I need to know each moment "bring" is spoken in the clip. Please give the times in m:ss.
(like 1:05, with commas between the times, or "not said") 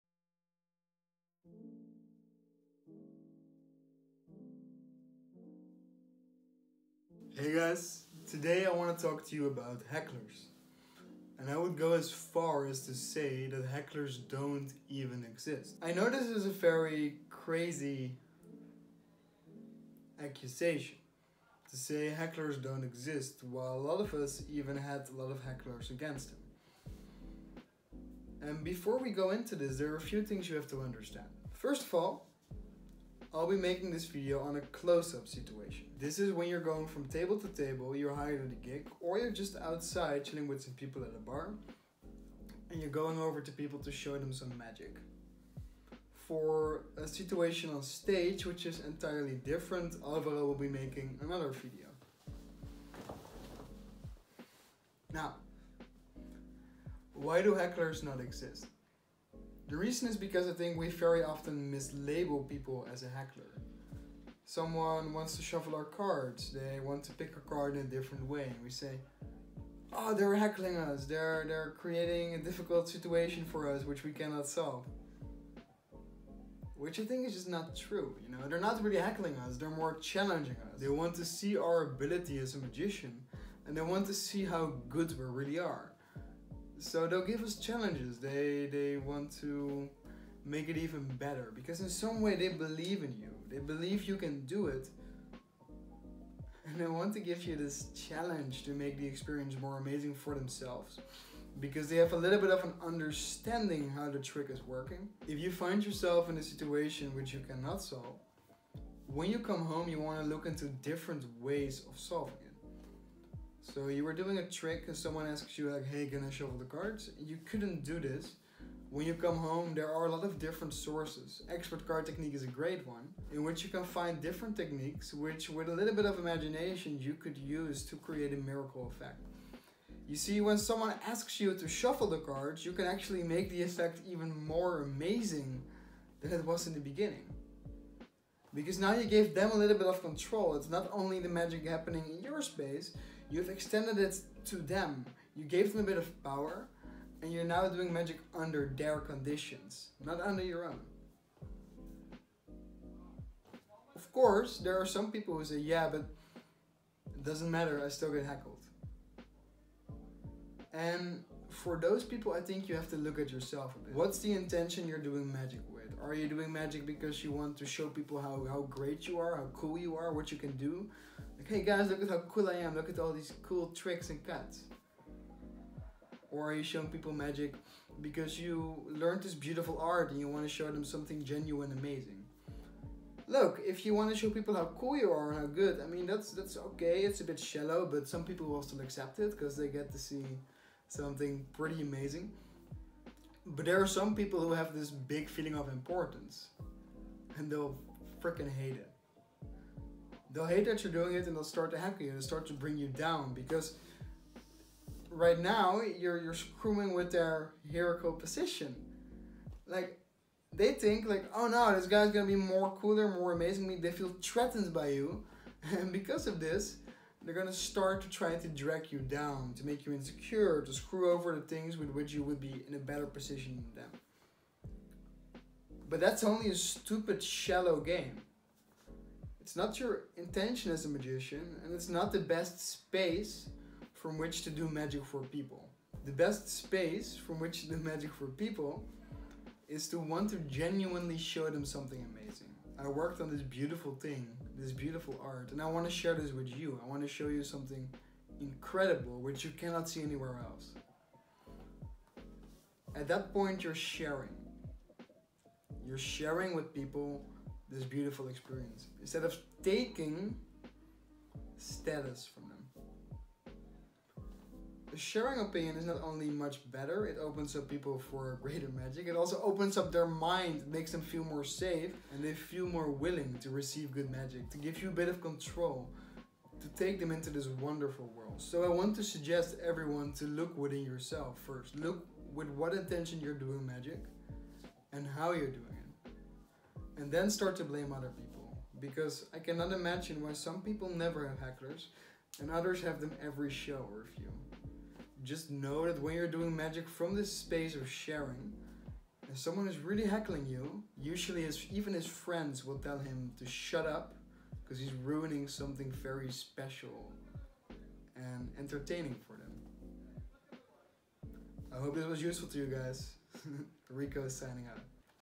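3:22.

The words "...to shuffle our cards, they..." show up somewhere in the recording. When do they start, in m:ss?
1:05.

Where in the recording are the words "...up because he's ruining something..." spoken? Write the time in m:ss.
5:03.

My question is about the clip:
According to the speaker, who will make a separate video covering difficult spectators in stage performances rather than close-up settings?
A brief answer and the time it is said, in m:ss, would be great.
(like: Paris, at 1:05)
Alvaro, at 0:50.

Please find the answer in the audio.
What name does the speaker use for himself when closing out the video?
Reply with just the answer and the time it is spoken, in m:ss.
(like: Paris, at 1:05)
Rico, at 5:13.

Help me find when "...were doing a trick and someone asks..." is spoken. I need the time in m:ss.
1:54.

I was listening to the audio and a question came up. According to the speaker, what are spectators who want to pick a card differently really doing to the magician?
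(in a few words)
challenging us.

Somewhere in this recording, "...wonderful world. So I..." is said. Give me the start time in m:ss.
4:37.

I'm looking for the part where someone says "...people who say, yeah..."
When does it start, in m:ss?
2:35.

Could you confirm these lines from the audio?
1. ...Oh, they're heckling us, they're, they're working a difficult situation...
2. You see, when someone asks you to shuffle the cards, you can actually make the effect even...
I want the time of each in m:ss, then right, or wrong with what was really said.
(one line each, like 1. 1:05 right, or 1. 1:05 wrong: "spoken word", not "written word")
1. 1:09 wrong: "creating", not "working"
2. 2:10 right.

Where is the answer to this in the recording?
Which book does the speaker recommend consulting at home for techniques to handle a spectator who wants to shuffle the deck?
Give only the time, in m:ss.
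2:01.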